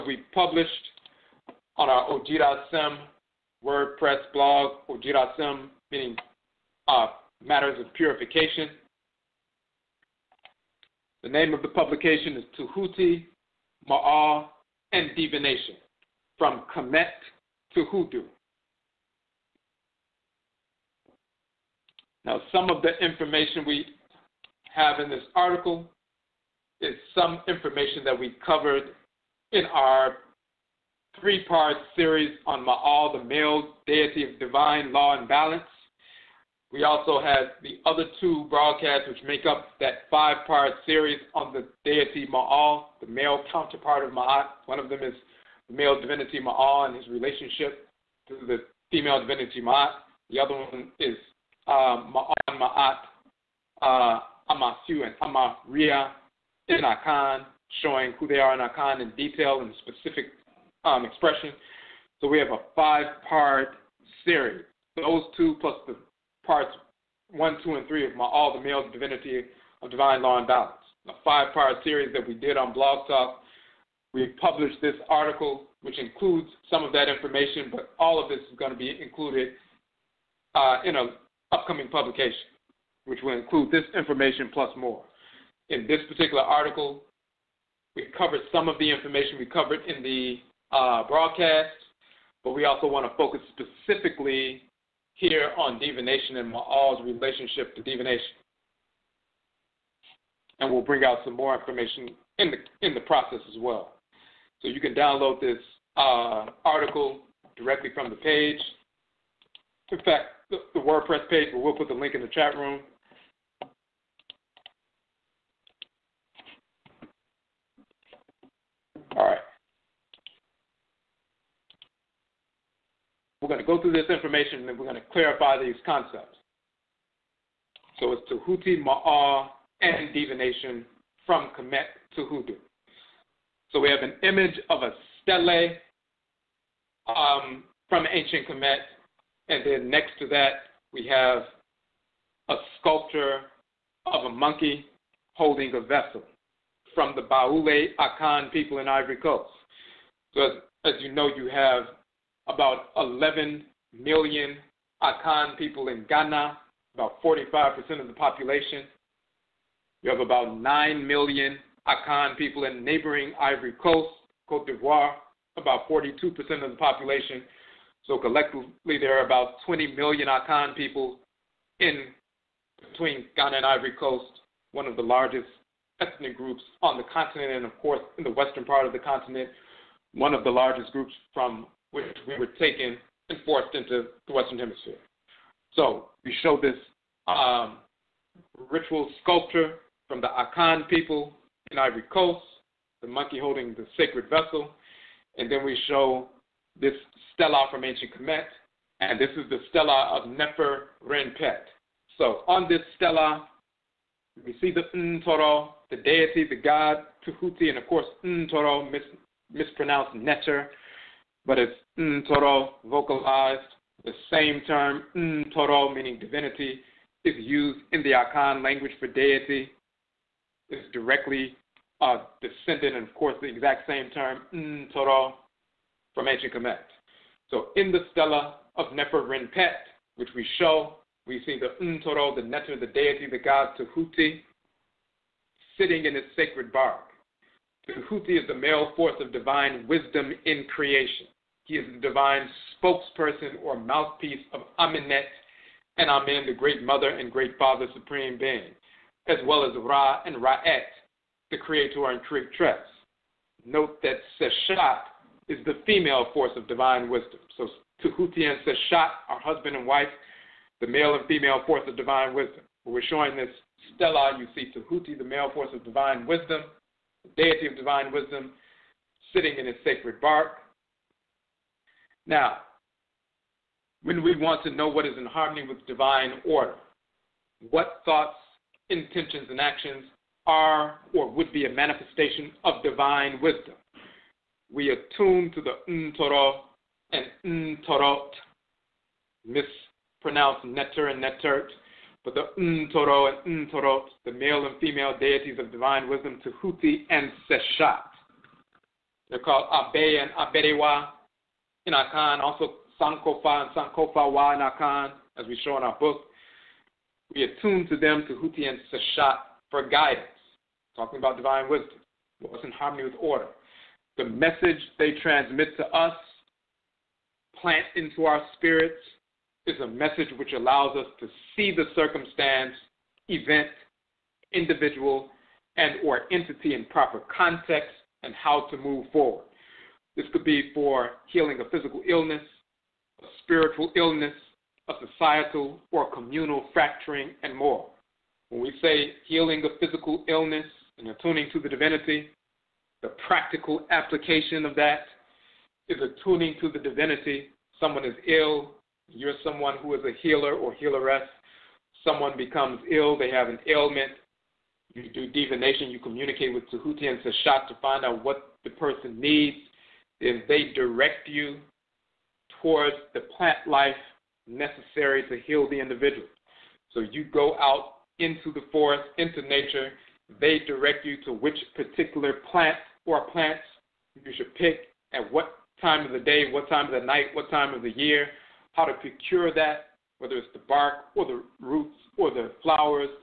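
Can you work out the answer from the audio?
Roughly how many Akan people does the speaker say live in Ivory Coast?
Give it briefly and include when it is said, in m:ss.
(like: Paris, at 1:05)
9 million, at 2:40.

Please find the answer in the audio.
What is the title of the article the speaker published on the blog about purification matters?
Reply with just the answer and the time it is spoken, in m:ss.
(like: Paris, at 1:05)
Tehuti, Maa, and Divination, from Kamit to Hoodoo, at 0:12.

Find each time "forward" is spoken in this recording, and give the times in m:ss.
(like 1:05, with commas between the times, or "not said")
5:29.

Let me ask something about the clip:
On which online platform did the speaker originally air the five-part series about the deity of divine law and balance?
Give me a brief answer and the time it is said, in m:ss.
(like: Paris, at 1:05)
Blog Talk, at 1:12.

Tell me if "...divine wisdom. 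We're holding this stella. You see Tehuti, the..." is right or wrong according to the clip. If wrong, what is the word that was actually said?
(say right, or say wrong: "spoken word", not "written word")
wrong: "showing", not "holding".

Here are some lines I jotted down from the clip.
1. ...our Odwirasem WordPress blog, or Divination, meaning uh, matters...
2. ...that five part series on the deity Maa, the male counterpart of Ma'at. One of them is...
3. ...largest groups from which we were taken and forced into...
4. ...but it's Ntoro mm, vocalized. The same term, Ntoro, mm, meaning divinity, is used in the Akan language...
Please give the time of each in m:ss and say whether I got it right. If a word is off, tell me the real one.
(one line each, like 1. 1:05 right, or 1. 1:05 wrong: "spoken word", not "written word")
1. 0:01 wrong: "Jirasim", not "Divination"
2. 0:39 right
3. 3:00 right
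4. 3:31 right.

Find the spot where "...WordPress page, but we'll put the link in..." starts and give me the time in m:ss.
1:50.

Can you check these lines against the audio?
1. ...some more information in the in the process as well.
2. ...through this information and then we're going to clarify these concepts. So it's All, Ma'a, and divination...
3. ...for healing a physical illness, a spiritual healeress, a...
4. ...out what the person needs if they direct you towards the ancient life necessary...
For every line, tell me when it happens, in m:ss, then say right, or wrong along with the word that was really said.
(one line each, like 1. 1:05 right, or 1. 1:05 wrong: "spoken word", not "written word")
1. 1:41 right
2. 2:03 wrong: "Tehuti", not "All"
3. 5:30 wrong: "illness", not "healeress"
4. 5:58 wrong: "plant", not "ancient".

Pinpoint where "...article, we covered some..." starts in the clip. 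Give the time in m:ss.
1:26.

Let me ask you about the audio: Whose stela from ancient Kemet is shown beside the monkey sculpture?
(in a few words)
Nefer Renpet.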